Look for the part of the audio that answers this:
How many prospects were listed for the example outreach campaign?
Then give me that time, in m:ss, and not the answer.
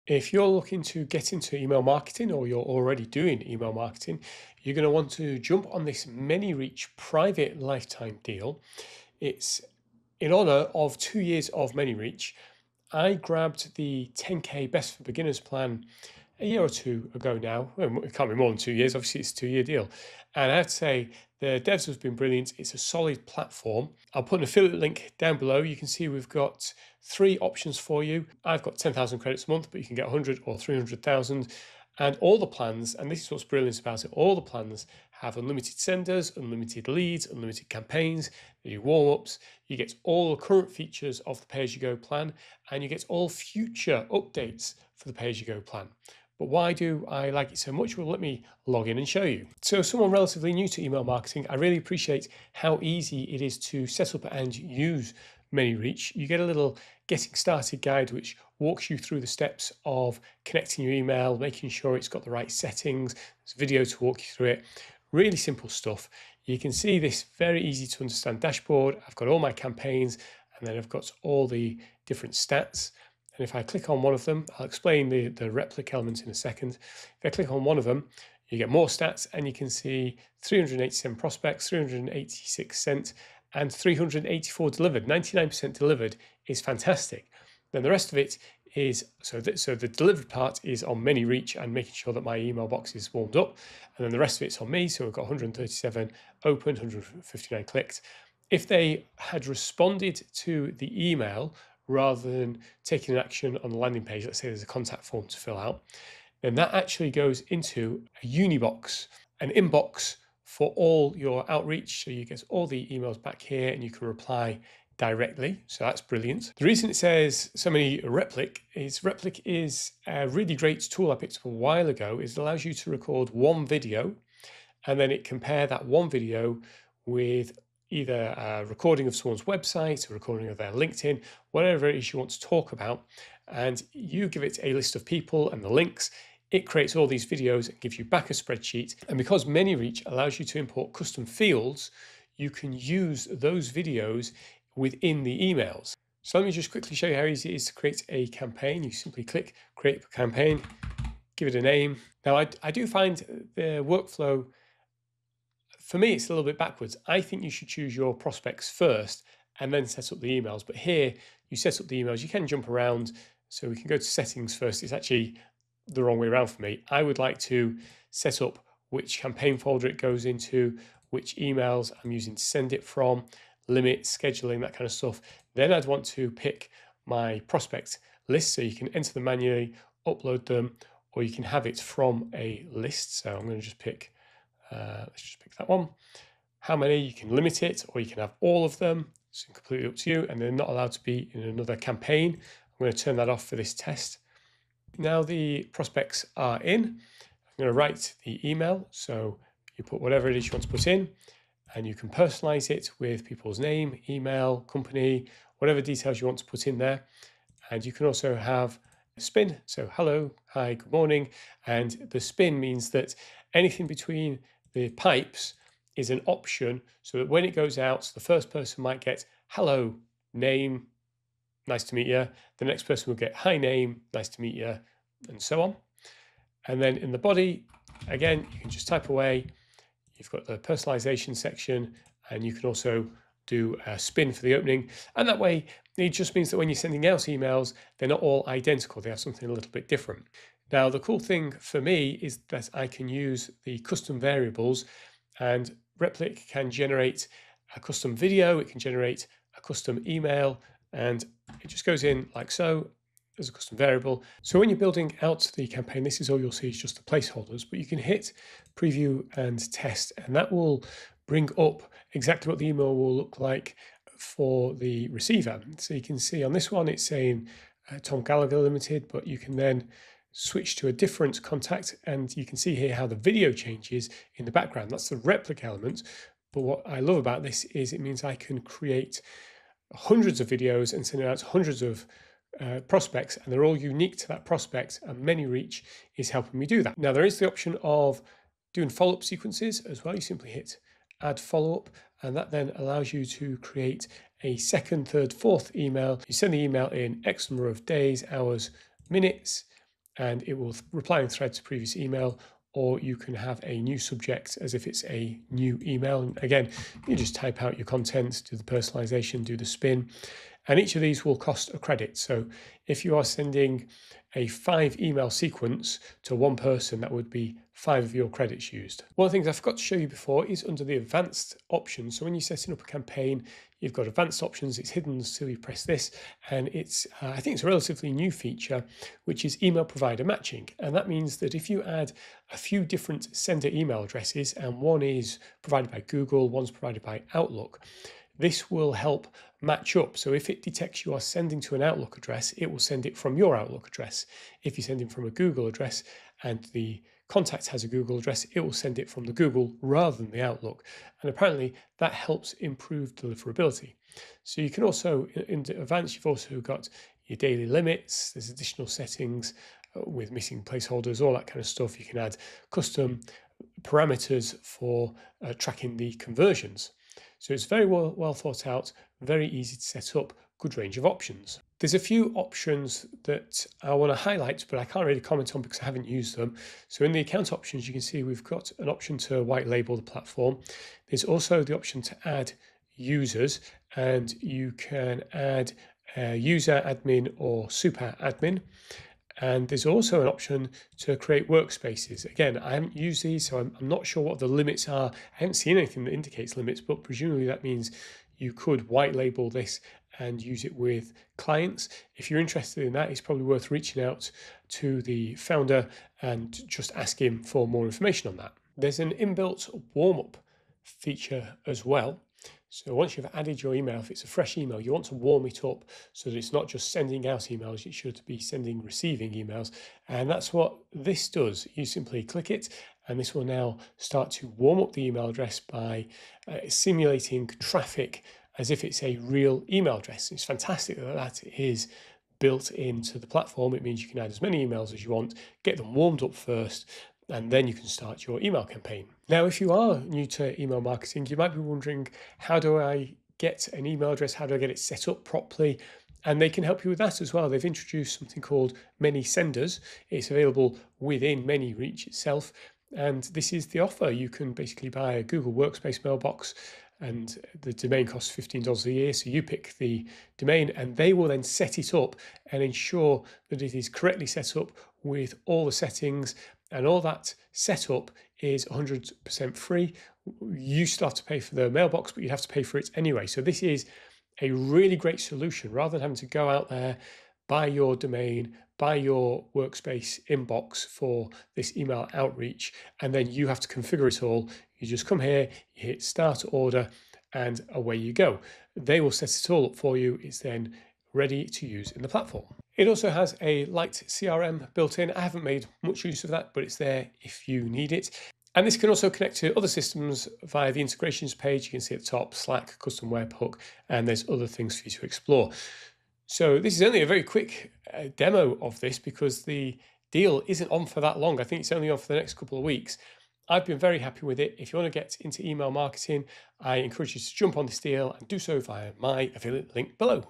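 1:20.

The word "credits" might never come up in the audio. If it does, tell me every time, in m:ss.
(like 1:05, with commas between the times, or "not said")
0:29, 5:11, 5:18.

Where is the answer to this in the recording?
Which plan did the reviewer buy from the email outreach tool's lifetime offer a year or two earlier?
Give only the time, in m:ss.
0:14.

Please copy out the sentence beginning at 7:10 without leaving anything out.
It's fantastic that that is built into the platform.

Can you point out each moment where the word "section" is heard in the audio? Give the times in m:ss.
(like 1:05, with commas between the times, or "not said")
3:51.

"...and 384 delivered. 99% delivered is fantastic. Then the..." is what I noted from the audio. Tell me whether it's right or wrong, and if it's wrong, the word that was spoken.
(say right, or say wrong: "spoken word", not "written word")
right.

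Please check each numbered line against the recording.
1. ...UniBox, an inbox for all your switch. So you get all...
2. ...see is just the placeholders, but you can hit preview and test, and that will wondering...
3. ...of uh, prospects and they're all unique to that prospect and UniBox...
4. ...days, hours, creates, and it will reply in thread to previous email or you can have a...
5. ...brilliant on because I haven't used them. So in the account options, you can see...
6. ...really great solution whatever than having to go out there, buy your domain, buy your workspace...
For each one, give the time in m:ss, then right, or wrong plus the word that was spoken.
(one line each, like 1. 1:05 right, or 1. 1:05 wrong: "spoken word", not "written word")
1. 1:48 wrong: "outreach", not "switch"
2. 4:16 wrong: "bring", not "wondering"
3. 4:41 wrong: "ManyReach", not "UniBox"
4. 4:57 wrong: "minutes", not "creates"
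5. 6:15 wrong: "comment", not "brilliant"
6. 7:54 wrong: "rather", not "whatever".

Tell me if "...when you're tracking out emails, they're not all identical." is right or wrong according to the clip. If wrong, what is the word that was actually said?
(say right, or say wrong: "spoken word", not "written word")
wrong: "sending", not "tracking".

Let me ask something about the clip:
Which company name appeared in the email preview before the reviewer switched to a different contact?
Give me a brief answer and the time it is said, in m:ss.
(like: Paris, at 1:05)
Tom Gallagher Limited, at 4:28.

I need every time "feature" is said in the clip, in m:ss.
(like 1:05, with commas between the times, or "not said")
0:40, 5:28, 6:50.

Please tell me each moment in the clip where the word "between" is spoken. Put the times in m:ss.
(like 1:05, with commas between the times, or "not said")
3:33.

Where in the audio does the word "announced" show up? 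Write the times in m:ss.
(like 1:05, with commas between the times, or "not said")
not said.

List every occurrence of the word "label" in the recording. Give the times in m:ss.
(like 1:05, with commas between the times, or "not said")
6:19, 6:39.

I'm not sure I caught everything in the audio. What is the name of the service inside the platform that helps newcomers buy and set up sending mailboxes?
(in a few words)
ManySenders.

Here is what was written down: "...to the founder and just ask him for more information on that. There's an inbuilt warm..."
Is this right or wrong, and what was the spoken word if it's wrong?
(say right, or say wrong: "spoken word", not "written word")
right.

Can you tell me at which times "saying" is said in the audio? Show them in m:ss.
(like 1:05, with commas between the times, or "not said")
4:27.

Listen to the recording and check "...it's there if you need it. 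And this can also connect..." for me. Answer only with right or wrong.
right.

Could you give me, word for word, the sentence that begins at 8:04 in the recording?
You just come here, you hit start order, and away you go.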